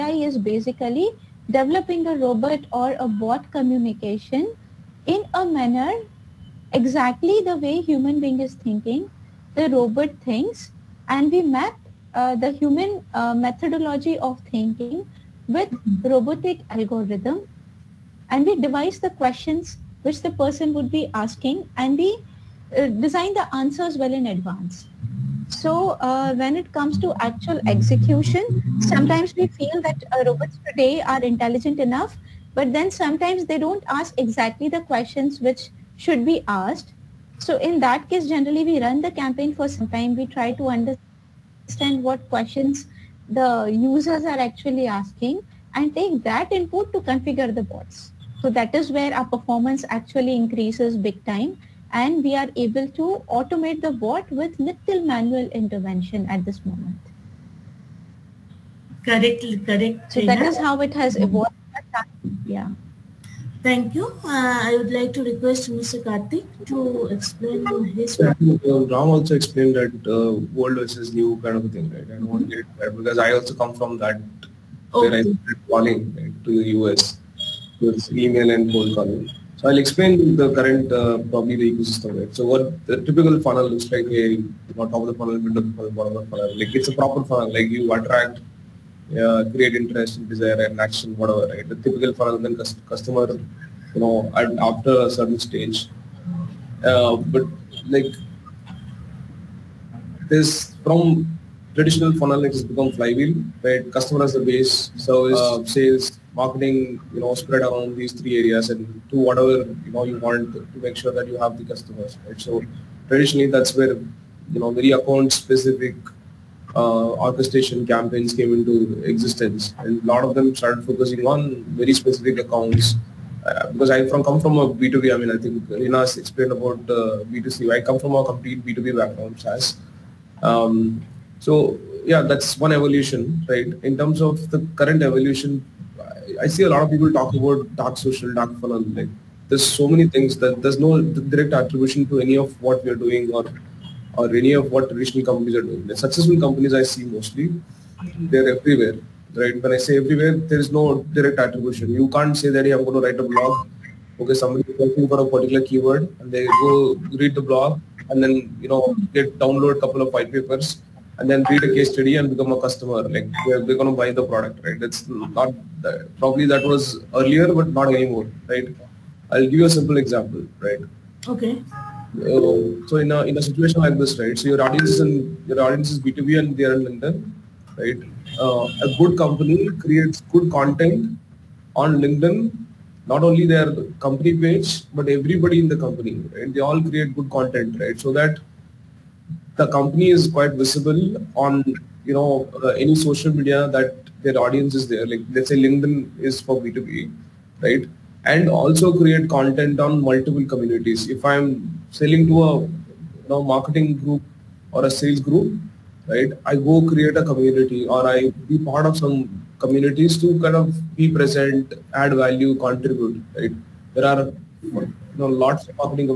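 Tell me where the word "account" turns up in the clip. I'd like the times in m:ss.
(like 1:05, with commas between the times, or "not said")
1:54, 2:02.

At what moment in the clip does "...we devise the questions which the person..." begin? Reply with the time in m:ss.
0:18.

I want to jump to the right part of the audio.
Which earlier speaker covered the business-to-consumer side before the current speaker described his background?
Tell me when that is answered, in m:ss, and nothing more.
2:05.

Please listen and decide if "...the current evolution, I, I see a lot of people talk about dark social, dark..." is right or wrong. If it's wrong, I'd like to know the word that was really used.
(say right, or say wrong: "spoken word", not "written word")
right.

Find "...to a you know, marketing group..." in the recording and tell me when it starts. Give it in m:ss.
3:22.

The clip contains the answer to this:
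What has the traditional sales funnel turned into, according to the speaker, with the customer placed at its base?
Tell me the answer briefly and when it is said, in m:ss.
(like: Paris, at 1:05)
flywheel, at 1:42.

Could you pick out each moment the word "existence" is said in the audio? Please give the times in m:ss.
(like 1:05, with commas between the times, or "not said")
1:59.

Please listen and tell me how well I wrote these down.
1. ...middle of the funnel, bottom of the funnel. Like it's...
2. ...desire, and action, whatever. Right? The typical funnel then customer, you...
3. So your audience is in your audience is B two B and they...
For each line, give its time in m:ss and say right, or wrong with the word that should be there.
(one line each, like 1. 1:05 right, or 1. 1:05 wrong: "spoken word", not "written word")
1. 1:25 right
2. 1:30 right
3. 2:54 right.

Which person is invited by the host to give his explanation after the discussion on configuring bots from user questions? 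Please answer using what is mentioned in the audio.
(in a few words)
Karthik.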